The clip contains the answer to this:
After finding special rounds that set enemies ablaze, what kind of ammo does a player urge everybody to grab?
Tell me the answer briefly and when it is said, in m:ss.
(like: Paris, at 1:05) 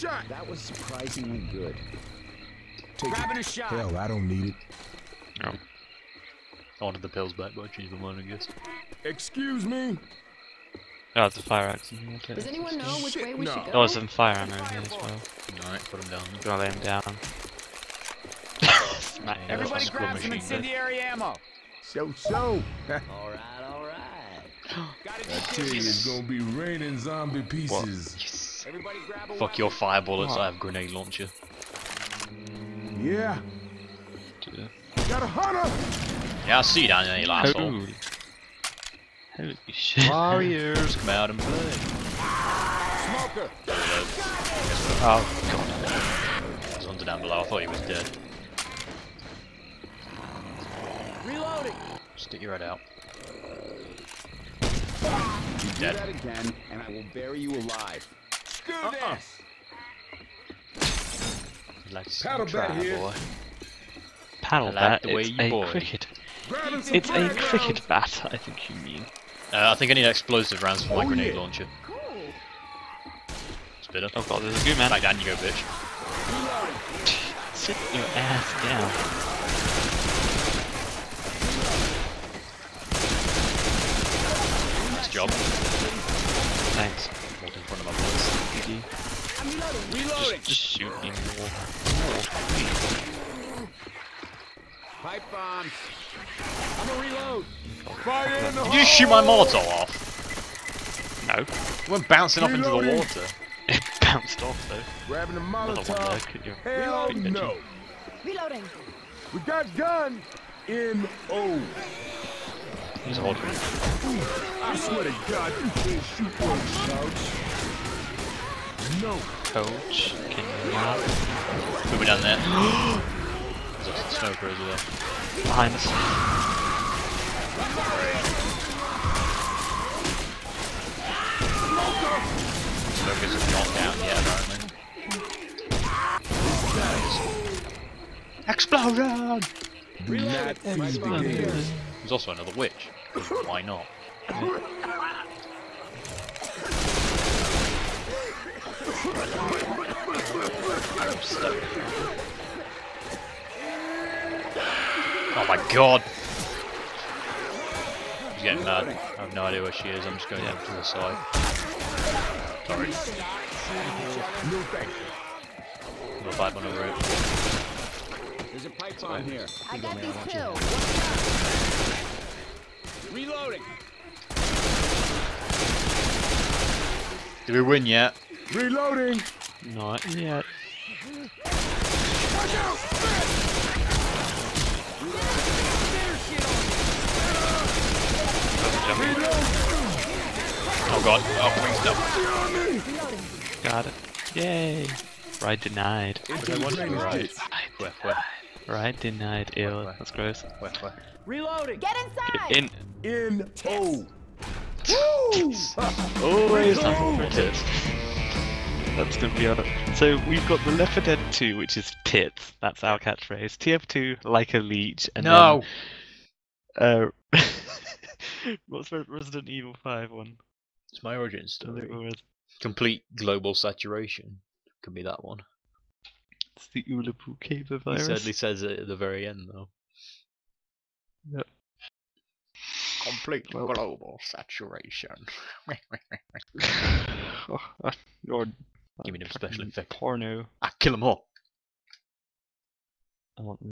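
incendiary ammo, at 0:20.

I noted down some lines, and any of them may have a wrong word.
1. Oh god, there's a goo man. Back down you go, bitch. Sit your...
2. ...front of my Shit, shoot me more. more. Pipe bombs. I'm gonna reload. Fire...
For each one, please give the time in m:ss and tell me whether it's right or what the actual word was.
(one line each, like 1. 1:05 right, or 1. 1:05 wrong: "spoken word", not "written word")
1. 1:14 right
2. 1:27 wrong: "Just", not "Shit".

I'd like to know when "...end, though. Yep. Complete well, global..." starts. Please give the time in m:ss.
3:49.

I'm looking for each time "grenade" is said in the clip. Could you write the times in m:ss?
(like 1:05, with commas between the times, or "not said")
0:30, 1:11.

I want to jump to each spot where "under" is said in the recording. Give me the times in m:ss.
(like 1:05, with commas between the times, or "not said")
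0:46.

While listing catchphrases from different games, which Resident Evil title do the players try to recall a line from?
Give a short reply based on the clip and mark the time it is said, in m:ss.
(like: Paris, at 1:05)
Resident Evil 5, at 3:38.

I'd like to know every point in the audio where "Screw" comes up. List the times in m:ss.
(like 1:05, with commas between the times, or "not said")
0:58.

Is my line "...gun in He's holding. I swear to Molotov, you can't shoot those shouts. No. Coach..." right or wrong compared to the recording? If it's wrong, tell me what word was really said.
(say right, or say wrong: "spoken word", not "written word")
wrong: "God", not "Molotov".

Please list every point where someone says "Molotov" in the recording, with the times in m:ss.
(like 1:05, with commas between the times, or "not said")
1:39, 1:45.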